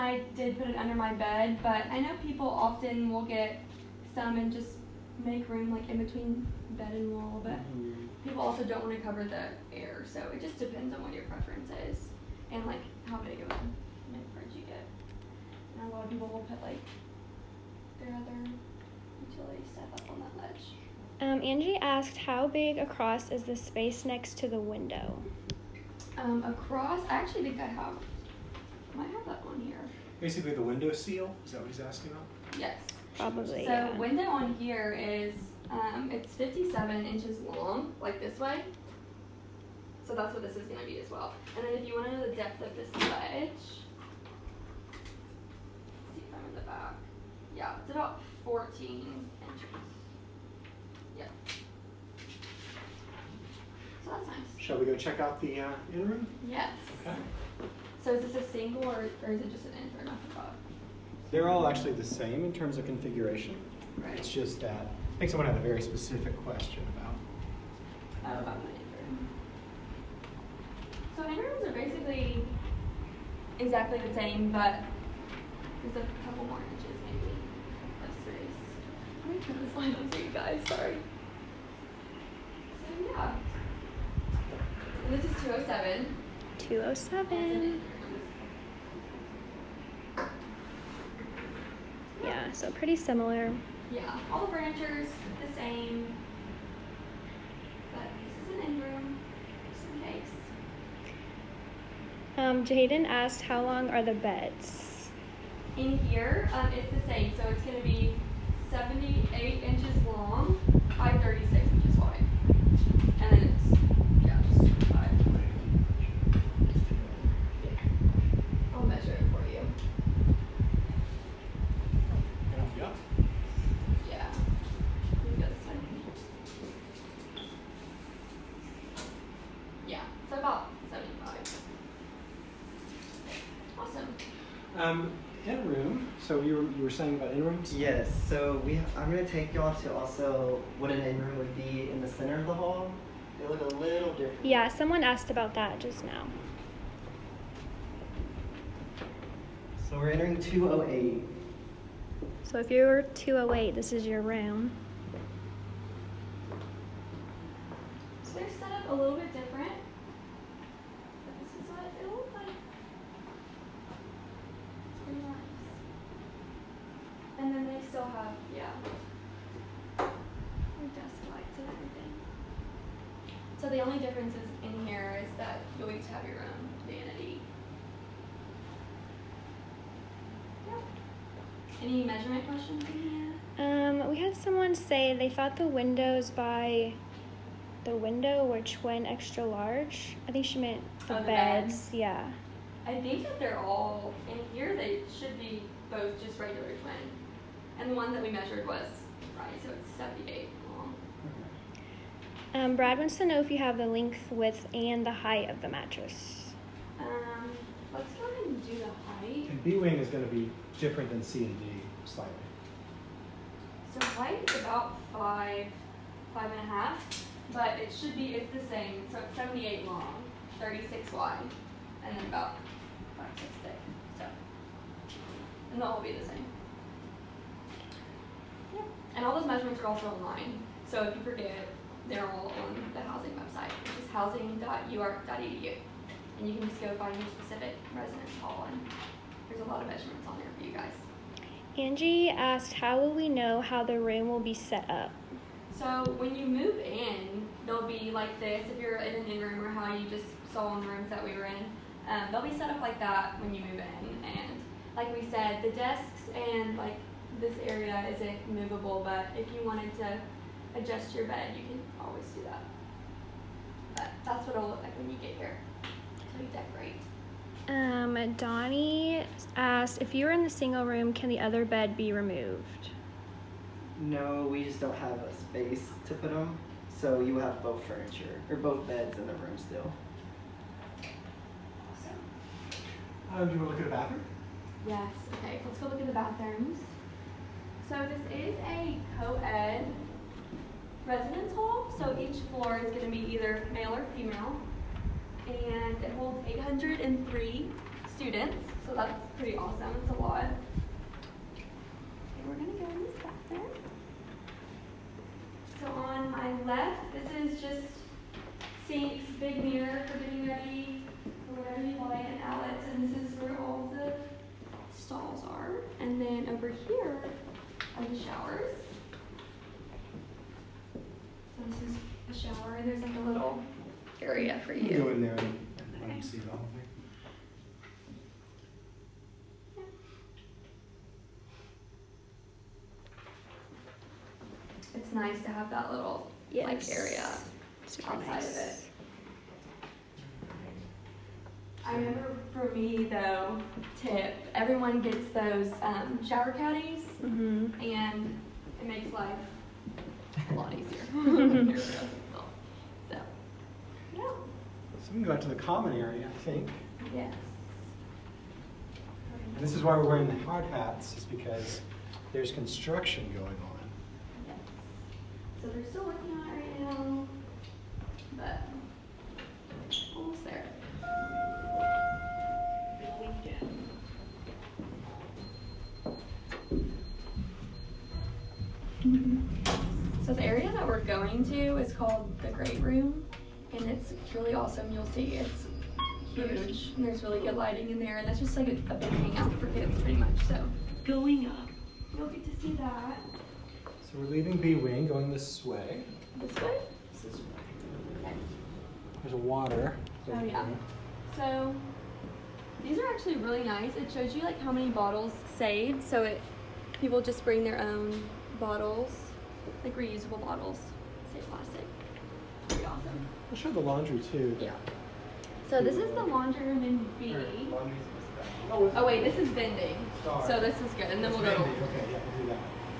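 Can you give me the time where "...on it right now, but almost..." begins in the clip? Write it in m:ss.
6:06.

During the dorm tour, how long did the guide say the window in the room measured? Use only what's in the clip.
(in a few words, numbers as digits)
57 inches.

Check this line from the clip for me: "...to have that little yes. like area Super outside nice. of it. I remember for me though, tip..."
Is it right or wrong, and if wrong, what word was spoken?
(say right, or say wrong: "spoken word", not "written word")
right.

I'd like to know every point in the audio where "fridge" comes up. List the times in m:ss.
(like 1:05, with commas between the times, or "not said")
0:14.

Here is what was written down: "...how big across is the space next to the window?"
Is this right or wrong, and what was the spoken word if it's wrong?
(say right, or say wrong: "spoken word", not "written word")
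right.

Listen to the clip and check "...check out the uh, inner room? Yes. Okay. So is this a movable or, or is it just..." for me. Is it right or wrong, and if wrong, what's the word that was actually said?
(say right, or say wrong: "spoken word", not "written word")
wrong: "single", not "movable".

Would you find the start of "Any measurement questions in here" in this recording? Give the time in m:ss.
3:01.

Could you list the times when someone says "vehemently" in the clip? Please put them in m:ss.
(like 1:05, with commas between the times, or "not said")
not said.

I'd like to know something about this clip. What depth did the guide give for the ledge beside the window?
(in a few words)
14 inches.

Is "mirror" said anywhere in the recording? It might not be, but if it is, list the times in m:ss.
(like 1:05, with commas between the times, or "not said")
5:09.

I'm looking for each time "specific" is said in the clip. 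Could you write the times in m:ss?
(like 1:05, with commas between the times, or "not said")
1:05, 3:57.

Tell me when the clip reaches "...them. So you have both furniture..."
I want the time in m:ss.
4:36.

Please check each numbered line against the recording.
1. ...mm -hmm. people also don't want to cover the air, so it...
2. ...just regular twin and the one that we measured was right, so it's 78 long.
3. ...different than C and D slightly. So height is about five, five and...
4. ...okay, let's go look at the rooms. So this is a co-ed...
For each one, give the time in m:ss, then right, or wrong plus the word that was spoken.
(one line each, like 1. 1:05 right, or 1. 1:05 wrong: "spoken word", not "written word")
1. 0:07 right
2. 3:16 right
3. 3:30 right
4. 4:45 wrong: "bathrooms", not "rooms".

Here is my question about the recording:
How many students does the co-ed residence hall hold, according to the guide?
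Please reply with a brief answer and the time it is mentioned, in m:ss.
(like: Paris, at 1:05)
803, at 4:56.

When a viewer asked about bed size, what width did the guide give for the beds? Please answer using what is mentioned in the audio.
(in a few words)
36 inches.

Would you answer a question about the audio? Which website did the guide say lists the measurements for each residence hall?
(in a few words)
housing.uark.edu.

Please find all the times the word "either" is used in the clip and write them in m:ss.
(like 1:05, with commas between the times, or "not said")
4:53.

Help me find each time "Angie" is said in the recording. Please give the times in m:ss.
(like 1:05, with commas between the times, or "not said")
0:21, 4:01.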